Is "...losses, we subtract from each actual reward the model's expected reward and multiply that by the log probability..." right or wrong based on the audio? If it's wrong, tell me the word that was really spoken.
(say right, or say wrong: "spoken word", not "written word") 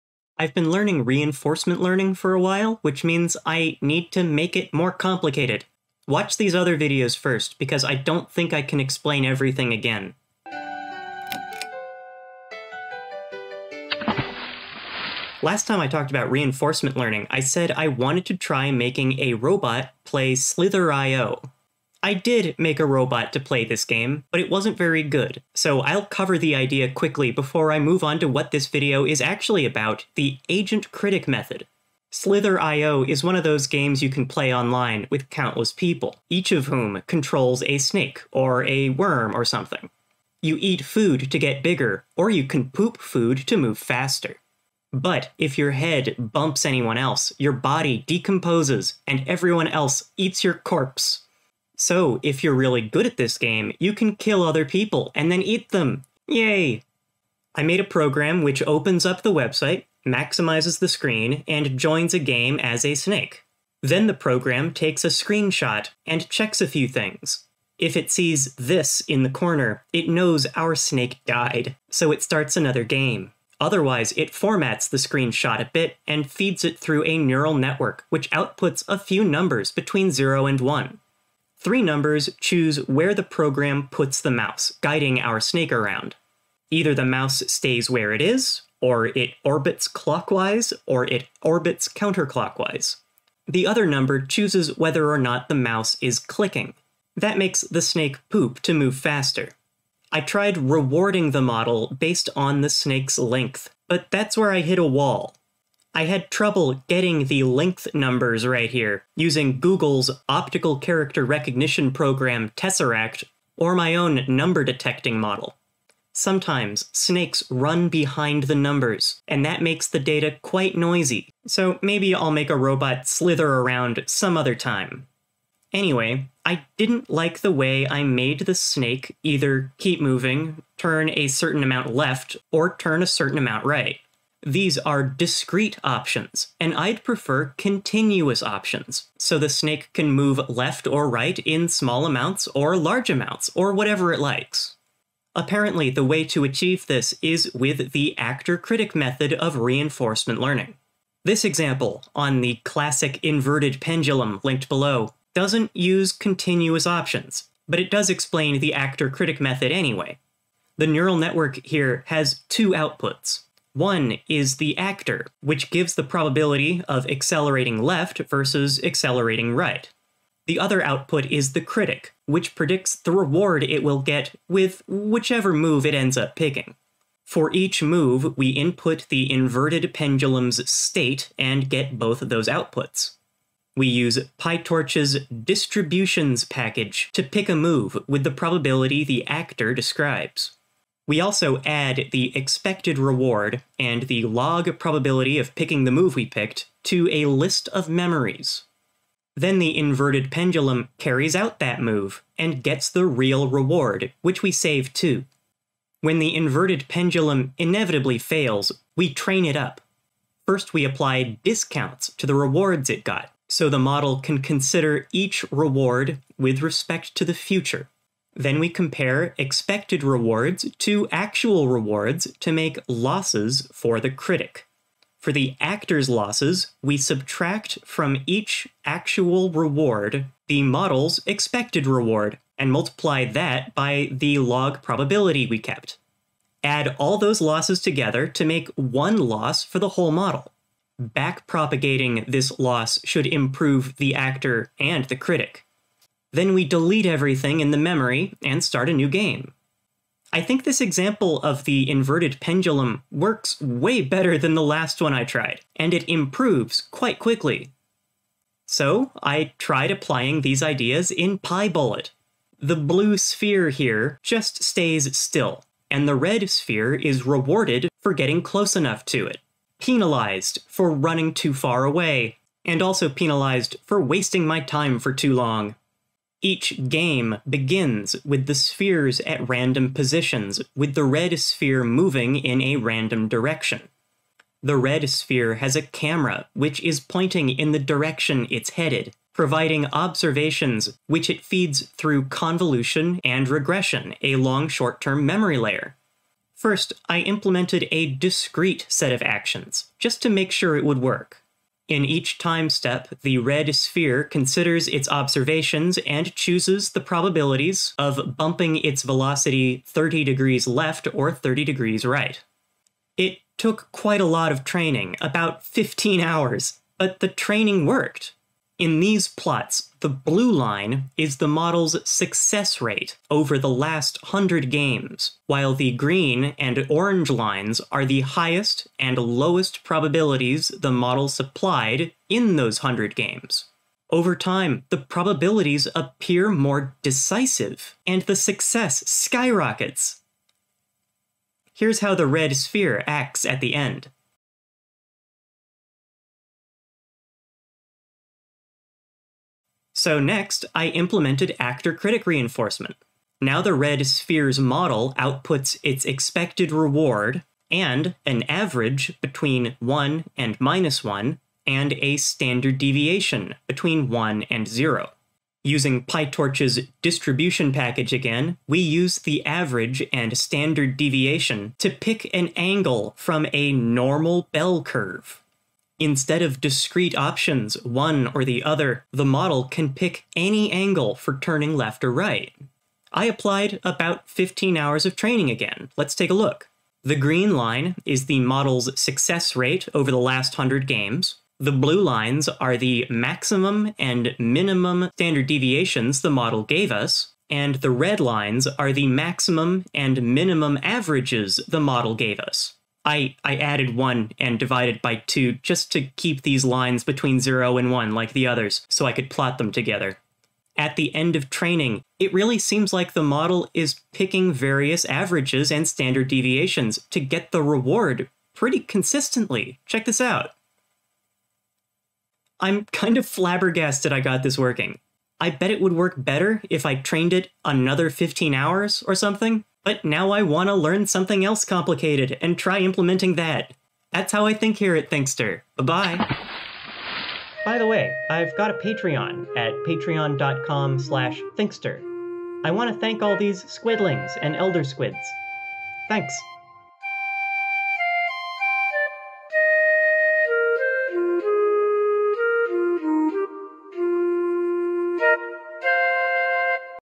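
right.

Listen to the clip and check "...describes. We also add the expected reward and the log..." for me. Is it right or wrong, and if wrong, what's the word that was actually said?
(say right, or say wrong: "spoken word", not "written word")
right.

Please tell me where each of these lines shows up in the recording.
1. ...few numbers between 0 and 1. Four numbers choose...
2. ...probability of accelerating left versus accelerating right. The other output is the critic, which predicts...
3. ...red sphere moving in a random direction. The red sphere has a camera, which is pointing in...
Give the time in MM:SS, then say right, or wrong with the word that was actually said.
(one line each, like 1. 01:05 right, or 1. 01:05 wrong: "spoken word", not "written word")
1. 01:18 wrong: "Three", not "Four"
2. 02:46 right
3. 04:41 right.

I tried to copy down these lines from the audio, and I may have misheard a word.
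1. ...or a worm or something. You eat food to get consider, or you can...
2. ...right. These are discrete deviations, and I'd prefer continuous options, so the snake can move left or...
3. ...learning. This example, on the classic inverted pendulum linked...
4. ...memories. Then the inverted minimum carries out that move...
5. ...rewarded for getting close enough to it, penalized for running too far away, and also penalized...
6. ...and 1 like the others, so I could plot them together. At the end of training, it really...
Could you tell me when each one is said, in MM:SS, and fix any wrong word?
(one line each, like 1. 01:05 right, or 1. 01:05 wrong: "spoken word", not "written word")
1. 00:38 wrong: "bigger", not "consider"
2. 02:13 wrong: "options", not "deviations"
3. 02:30 right
4. 03:17 wrong: "pendulum", not "minimum"
5. 04:27 right
6. 06:47 right.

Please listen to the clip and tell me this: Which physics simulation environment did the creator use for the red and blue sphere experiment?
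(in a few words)
PyBullet.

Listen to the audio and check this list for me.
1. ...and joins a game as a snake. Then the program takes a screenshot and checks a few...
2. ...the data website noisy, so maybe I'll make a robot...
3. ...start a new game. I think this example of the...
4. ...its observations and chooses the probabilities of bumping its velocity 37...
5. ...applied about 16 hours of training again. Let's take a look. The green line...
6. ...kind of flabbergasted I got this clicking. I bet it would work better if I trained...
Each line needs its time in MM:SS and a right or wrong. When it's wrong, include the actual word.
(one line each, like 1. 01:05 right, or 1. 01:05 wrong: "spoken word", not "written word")
1. 01:01 right
2. 01:59 wrong: "quite", not "website"
3. 04:08 right
4. 05:04 wrong: "30", not "37"
5. 06:23 wrong: "15", not "16"
6. 07:02 wrong: "working", not "clicking".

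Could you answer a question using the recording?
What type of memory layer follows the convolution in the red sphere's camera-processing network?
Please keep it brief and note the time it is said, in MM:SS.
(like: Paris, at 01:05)
long short term memory, at 04:54.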